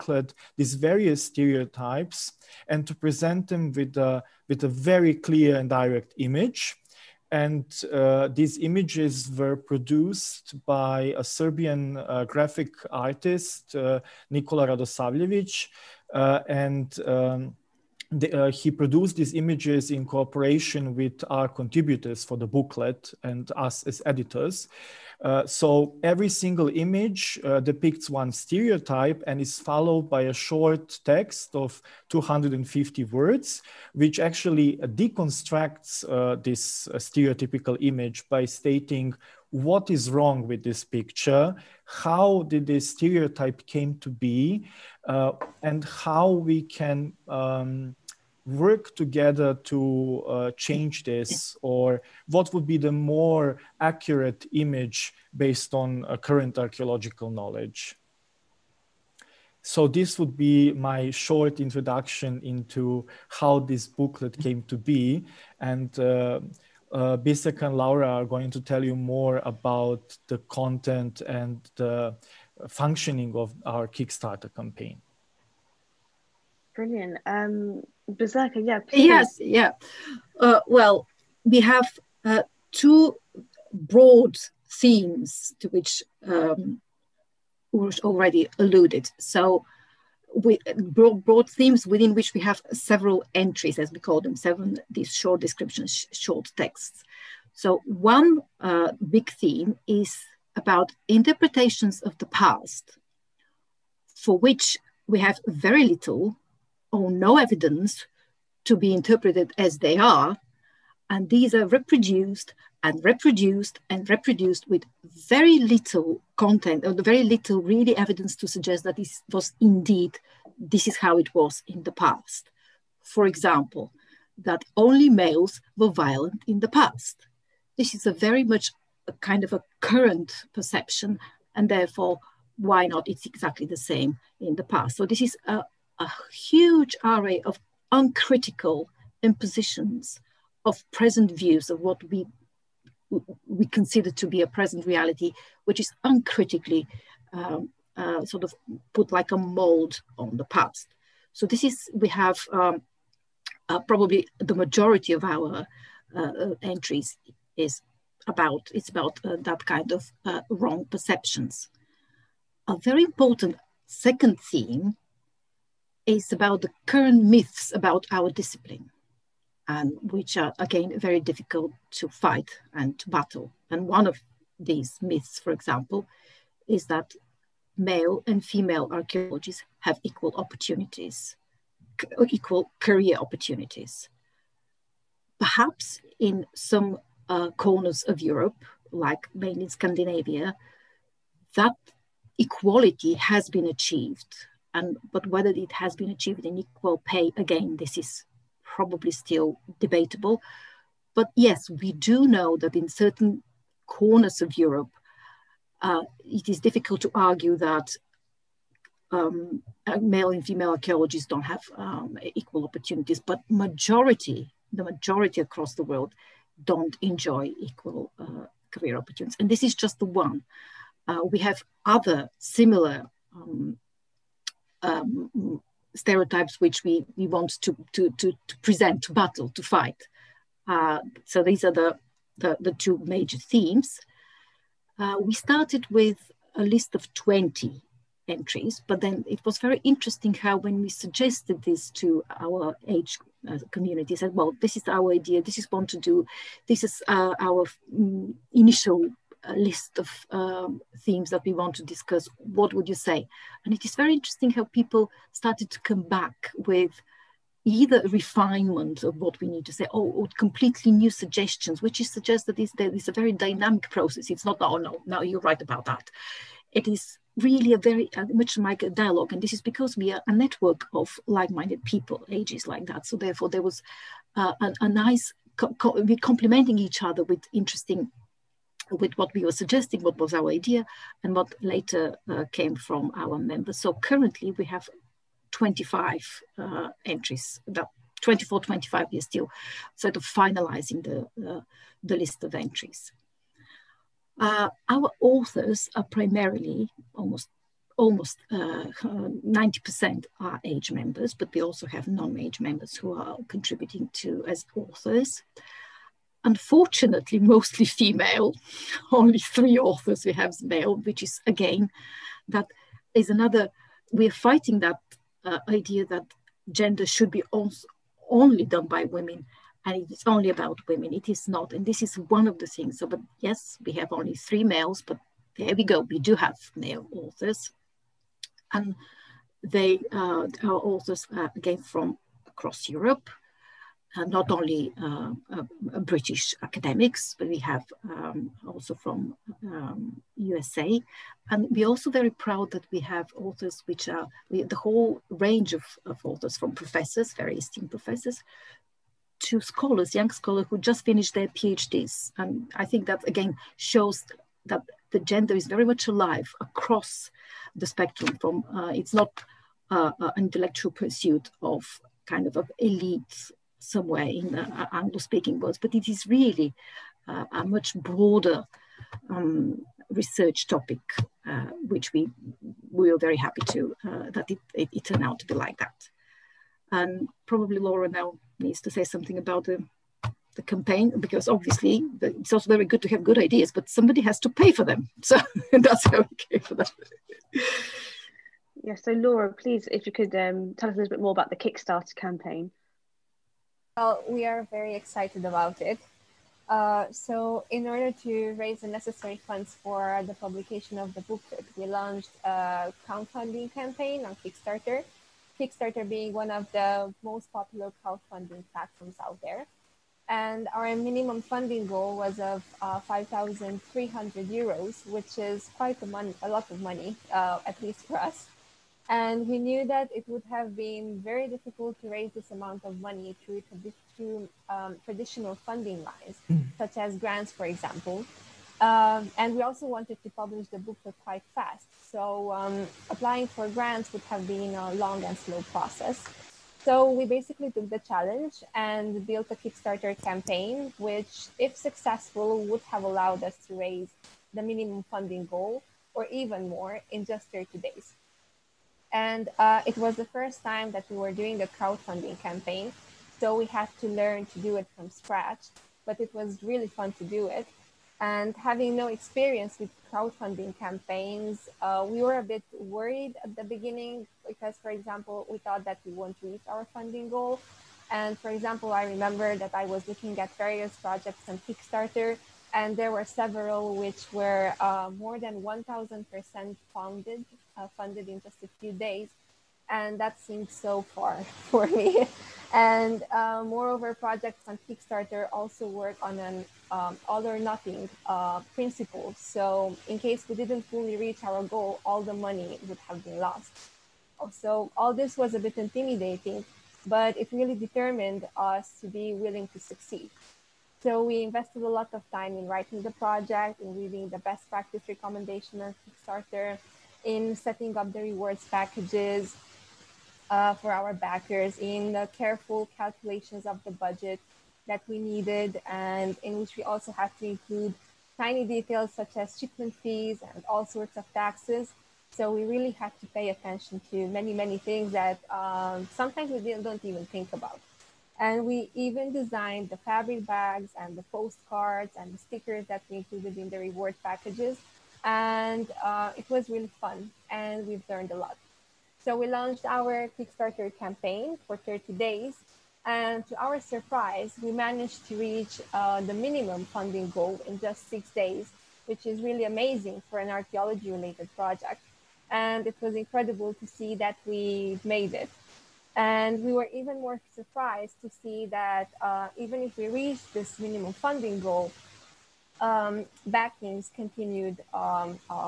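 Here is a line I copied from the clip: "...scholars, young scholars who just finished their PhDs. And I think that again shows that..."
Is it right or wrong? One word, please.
right.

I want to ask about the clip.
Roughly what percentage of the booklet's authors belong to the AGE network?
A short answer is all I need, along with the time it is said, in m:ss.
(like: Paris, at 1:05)
90%, at 4:58.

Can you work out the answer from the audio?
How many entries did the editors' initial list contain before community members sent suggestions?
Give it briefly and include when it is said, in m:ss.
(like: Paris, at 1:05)
20, at 3:57.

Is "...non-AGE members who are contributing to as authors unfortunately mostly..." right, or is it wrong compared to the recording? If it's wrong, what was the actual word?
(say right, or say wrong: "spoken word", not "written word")
right.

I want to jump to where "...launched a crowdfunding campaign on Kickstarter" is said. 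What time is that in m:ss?
6:41.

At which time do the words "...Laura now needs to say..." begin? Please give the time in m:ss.
6:17.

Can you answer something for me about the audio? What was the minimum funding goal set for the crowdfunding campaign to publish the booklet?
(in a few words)
5,300 euros.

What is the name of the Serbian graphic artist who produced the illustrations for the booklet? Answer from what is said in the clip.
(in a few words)
Nikola Radosavljevic.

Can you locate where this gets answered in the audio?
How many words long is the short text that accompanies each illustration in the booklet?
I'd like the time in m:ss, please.
0:32.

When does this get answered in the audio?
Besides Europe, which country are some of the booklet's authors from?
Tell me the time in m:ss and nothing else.
5:40.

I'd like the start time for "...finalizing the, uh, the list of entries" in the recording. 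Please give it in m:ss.
4:50.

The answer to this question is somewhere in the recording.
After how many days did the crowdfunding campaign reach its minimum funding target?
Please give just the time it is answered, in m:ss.
9:08.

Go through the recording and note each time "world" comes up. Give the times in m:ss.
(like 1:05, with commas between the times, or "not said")
3:35, 6:05.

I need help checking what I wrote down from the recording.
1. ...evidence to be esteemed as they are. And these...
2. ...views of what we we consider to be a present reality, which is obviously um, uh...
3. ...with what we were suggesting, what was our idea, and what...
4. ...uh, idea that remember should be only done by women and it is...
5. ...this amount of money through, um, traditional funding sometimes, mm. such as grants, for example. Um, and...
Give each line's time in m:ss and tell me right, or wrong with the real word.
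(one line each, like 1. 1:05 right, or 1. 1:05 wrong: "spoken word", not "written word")
1. 1:47 wrong: "interpreted", not "esteemed"
2. 2:21 wrong: "uncritically", not "obviously"
3. 4:38 right
4. 5:15 wrong: "gender", not "remember"
5. 7:02 wrong: "lines", not "sometimes".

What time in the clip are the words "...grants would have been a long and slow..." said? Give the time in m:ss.
7:13.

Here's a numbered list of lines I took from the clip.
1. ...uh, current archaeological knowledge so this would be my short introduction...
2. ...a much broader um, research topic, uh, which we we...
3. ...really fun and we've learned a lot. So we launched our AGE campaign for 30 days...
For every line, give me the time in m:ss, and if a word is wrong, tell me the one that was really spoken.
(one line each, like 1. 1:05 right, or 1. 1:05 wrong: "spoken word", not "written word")
1. 0:56 right
2. 6:07 right
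3. 8:56 wrong: "Kickstarter", not "AGE".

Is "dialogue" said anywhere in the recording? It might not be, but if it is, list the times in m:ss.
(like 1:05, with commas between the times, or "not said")
4:28.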